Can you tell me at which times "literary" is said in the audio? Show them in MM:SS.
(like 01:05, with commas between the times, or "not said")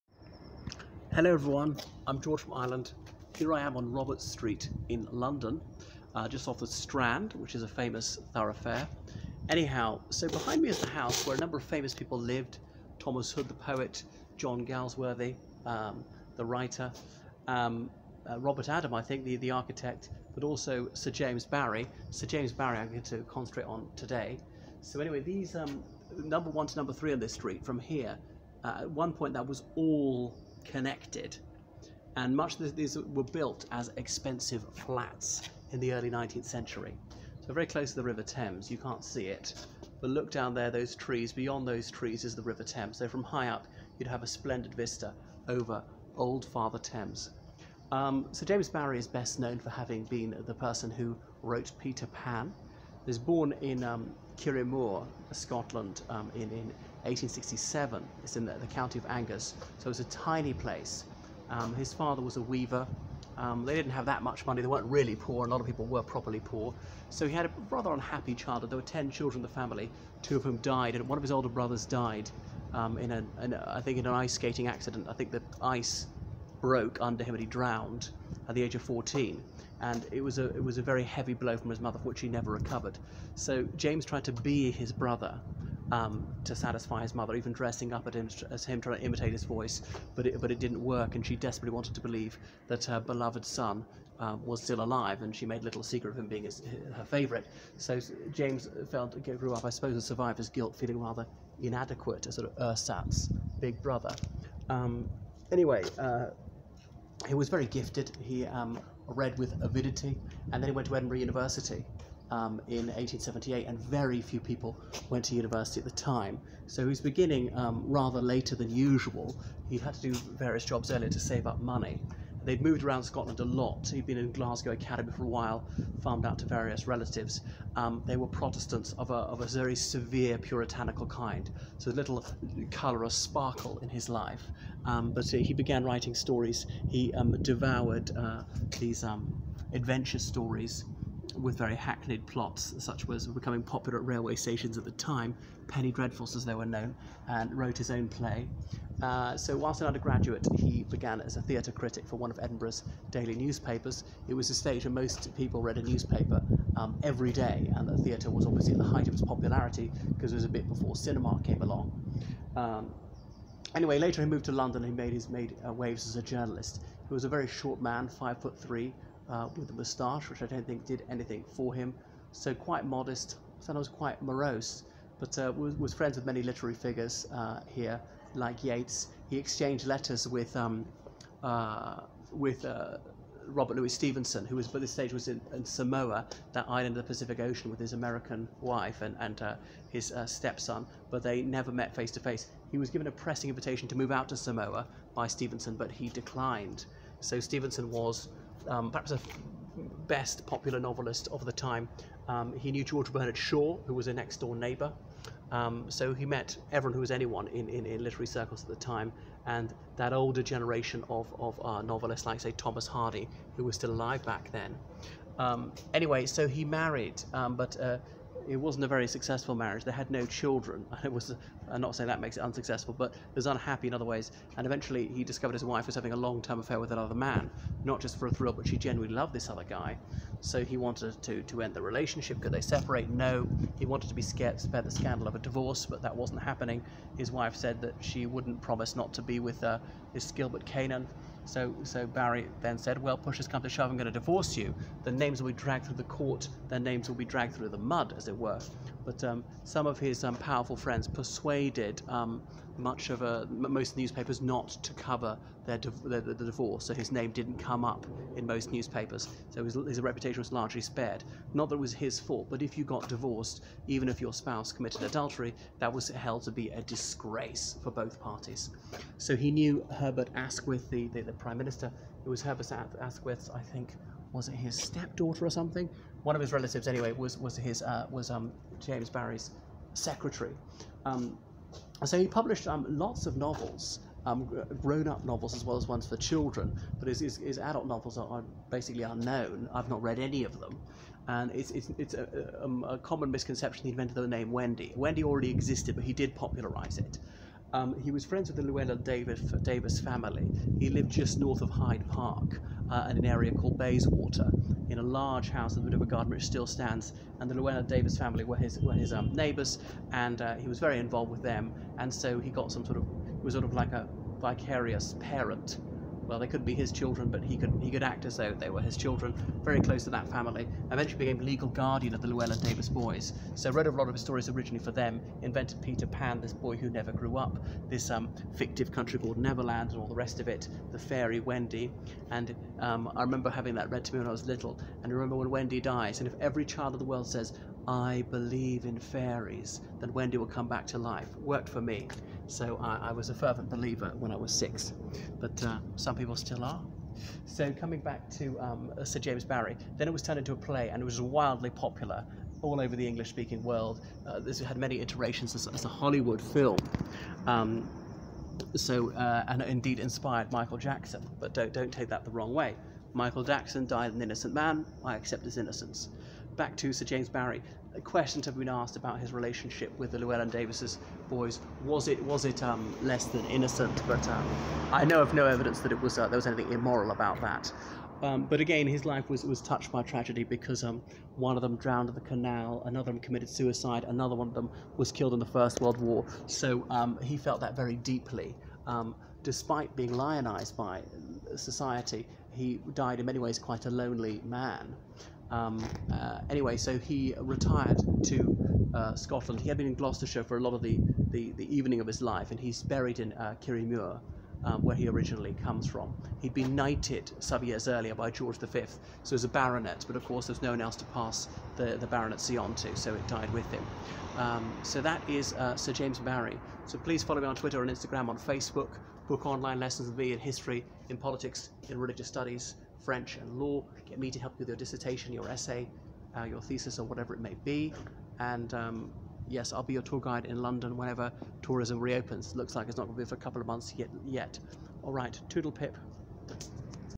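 02:56, 03:28.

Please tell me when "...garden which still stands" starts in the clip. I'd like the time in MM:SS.
05:06.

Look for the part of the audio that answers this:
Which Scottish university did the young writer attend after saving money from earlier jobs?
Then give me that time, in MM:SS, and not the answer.
01:50.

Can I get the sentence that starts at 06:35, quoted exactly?
Um, uh, anyway, so he retired to uh, Scotland.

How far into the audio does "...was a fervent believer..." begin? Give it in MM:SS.
05:43.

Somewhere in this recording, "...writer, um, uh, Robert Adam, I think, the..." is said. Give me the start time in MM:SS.
00:16.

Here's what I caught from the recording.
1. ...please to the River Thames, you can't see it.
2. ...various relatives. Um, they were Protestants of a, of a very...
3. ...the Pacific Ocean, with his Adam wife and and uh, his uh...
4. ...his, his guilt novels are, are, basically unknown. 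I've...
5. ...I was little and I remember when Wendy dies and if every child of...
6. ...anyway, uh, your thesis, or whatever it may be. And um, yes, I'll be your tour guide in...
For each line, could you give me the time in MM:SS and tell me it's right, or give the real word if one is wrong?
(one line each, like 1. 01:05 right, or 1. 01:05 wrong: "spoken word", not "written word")
1. 00:37 wrong: "close", not "please"
2. 02:06 right
3. 03:07 wrong: "American", not "Adam"
4. 04:47 wrong: "adult", not "guilt"
5. 05:34 right
6. 07:05 wrong: "essay", not "anyway".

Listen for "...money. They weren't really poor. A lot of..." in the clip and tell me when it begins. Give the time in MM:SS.
01:04.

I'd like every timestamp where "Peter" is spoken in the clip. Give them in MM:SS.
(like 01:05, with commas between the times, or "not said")
00:51, 05:25.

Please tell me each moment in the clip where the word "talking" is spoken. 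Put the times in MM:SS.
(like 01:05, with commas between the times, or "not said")
not said.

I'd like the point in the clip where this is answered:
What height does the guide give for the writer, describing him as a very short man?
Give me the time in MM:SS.
02:48.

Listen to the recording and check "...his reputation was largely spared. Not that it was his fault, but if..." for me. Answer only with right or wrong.
right.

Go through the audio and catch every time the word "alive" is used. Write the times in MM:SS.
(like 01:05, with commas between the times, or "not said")
01:34, 03:33.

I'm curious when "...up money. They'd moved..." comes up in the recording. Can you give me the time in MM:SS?
02:01.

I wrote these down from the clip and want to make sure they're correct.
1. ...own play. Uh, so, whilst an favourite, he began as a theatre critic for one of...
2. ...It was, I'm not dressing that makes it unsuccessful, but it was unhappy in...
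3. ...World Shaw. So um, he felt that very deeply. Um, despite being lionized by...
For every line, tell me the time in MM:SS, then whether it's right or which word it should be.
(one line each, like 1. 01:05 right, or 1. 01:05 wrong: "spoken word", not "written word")
1. 02:27 wrong: "undergraduate", not "favourite"
2. 03:41 wrong: "saying", not "dressing"
3. 06:25 wrong: "War", not "Shaw".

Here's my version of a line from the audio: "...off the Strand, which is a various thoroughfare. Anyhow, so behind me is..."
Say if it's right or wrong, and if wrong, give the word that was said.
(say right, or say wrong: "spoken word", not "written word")
wrong: "famous", not "various".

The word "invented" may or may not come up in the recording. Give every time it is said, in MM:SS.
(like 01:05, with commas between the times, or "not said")
04:53, 05:25.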